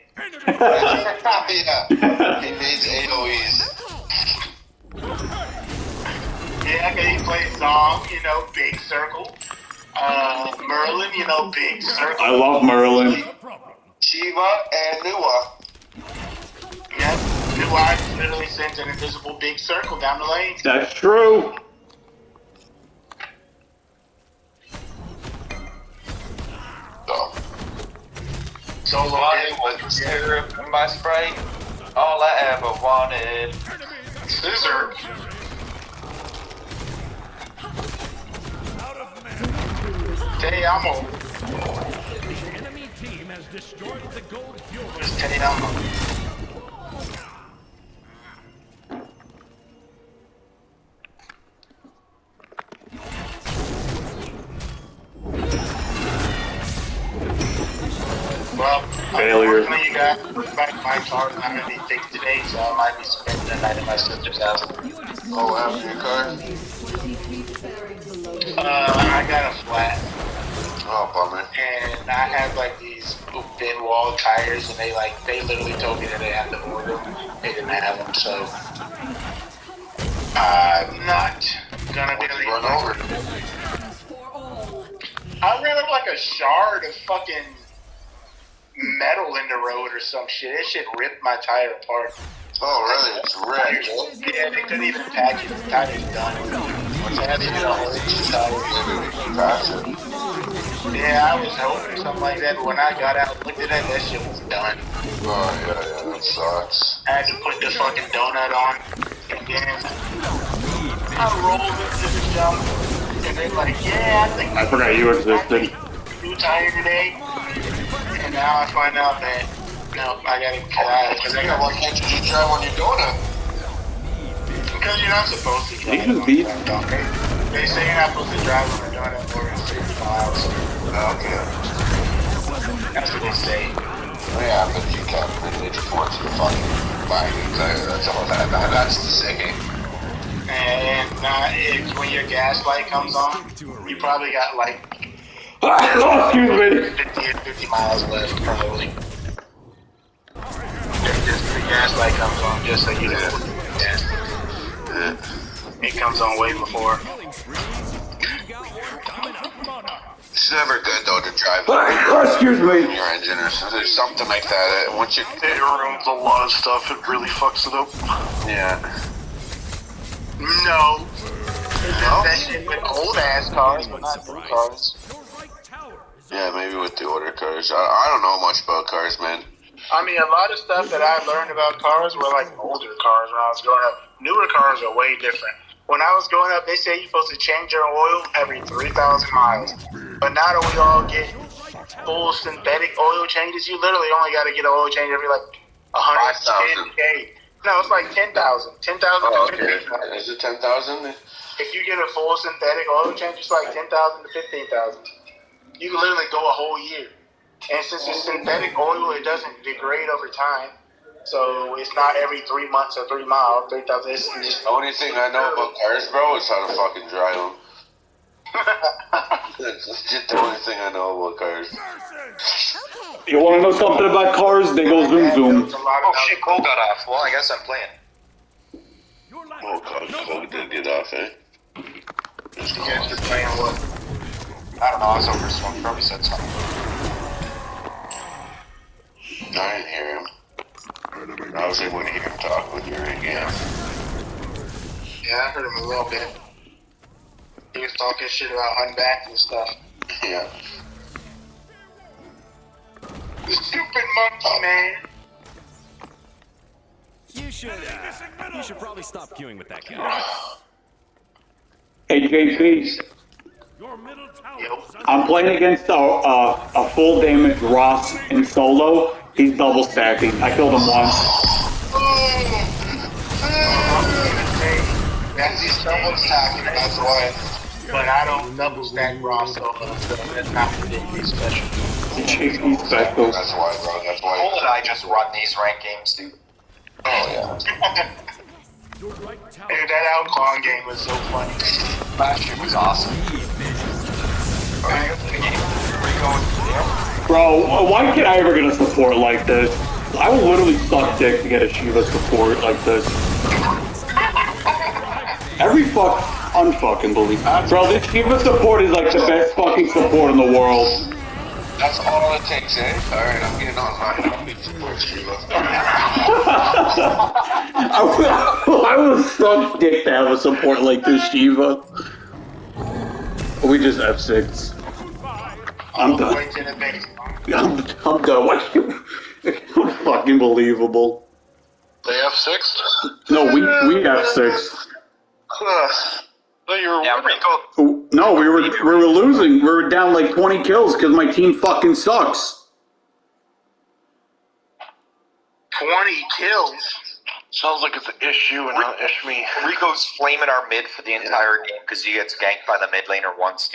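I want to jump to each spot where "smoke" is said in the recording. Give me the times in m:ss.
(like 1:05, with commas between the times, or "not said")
3:55.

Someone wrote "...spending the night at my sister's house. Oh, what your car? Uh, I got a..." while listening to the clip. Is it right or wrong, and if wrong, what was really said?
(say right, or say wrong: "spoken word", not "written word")
right.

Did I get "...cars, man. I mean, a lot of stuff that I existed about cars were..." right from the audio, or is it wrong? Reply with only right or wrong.
wrong.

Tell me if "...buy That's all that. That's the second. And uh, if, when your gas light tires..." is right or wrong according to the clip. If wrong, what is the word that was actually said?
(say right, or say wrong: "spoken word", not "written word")
wrong: "comes", not "tires".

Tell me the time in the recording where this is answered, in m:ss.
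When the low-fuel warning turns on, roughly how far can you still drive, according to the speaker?
2:27.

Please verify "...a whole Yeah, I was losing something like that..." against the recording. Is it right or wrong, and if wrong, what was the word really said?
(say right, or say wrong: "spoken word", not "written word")
wrong: "hoping", not "losing".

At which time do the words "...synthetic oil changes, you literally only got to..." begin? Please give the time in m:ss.
3:12.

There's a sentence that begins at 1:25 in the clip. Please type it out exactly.
I ran up like a shard of fucking metal in the road or some shit.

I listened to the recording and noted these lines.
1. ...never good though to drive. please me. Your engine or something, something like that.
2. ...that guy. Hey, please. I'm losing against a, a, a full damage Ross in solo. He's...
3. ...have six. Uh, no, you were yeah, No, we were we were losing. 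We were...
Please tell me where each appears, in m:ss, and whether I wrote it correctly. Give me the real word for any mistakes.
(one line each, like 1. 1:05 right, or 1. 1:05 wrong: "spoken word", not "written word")
1. 2:40 wrong: "excuse", not "please"
2. 4:19 wrong: "playing", not "losing"
3. 5:34 right.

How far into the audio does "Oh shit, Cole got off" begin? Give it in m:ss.
3:45.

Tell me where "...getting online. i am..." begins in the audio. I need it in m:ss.
5:13.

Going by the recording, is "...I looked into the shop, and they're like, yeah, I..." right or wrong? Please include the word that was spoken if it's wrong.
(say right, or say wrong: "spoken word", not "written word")
wrong: "rolled", not "looked".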